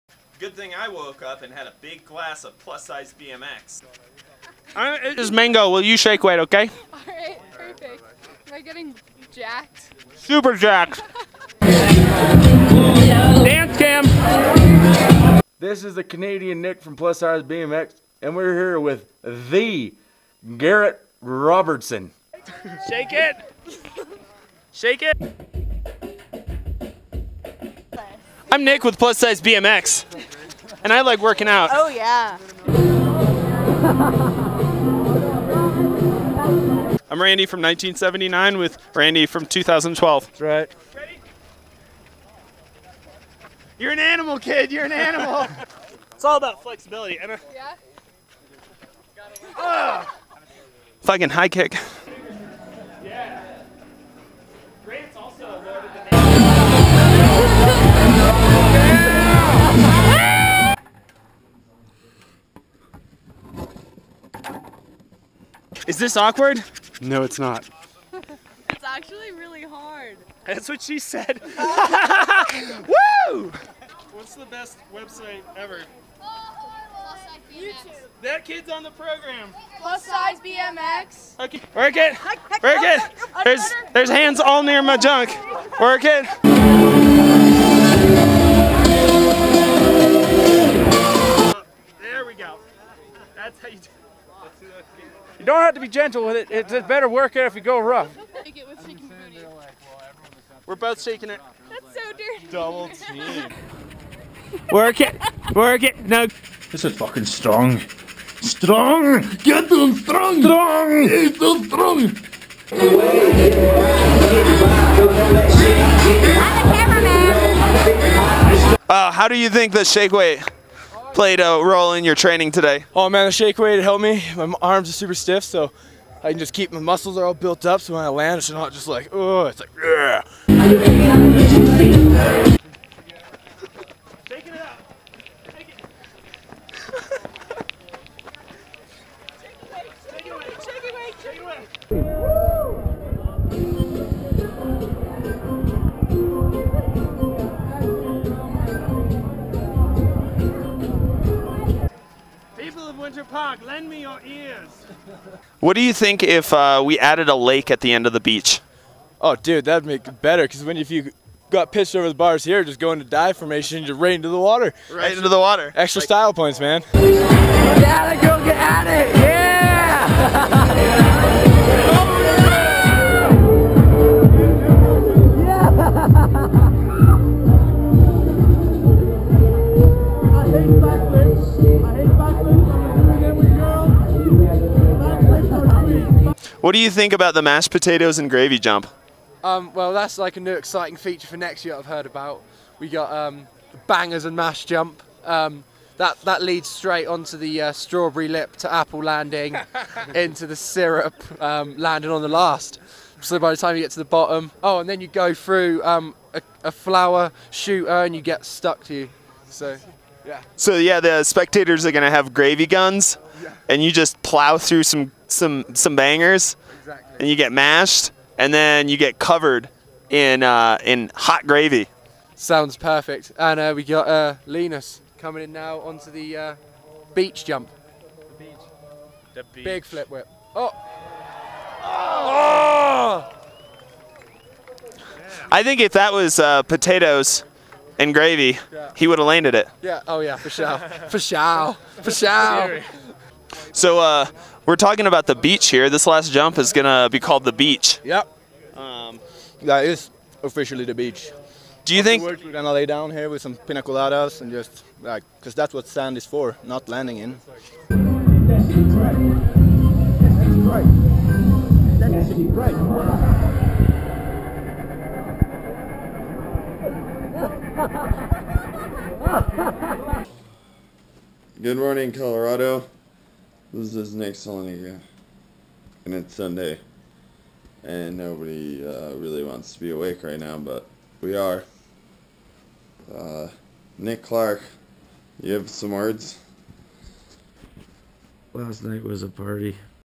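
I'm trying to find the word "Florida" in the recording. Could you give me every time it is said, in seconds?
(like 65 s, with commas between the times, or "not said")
not said.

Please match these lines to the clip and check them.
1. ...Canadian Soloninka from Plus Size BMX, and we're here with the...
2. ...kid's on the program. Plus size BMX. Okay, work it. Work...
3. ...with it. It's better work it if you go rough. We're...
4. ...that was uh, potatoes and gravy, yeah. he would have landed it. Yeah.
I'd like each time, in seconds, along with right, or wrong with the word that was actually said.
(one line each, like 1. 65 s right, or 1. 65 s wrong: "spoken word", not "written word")
1. 16 s wrong: "Nick", not "Soloninka"
2. 78 s right
3. 96 s right
4. 235 s right.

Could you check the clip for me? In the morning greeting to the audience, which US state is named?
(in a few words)
Colorado.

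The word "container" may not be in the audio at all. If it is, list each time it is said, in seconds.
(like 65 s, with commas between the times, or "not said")
not said.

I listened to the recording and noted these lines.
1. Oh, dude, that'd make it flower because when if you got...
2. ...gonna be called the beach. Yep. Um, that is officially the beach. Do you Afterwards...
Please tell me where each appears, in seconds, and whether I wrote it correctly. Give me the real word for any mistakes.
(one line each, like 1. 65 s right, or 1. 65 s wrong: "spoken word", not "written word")
1. 159 s wrong: "better", not "flower"
2. 246 s right.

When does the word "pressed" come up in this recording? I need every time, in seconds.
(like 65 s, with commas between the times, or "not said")
not said.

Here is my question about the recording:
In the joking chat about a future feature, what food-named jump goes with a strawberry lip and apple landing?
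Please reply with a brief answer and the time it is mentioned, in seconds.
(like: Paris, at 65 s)
bangers and mash jump, at 193 s.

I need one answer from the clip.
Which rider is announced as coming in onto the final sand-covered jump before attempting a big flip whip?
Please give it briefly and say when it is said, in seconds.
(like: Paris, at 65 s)
Linus, at 224 s.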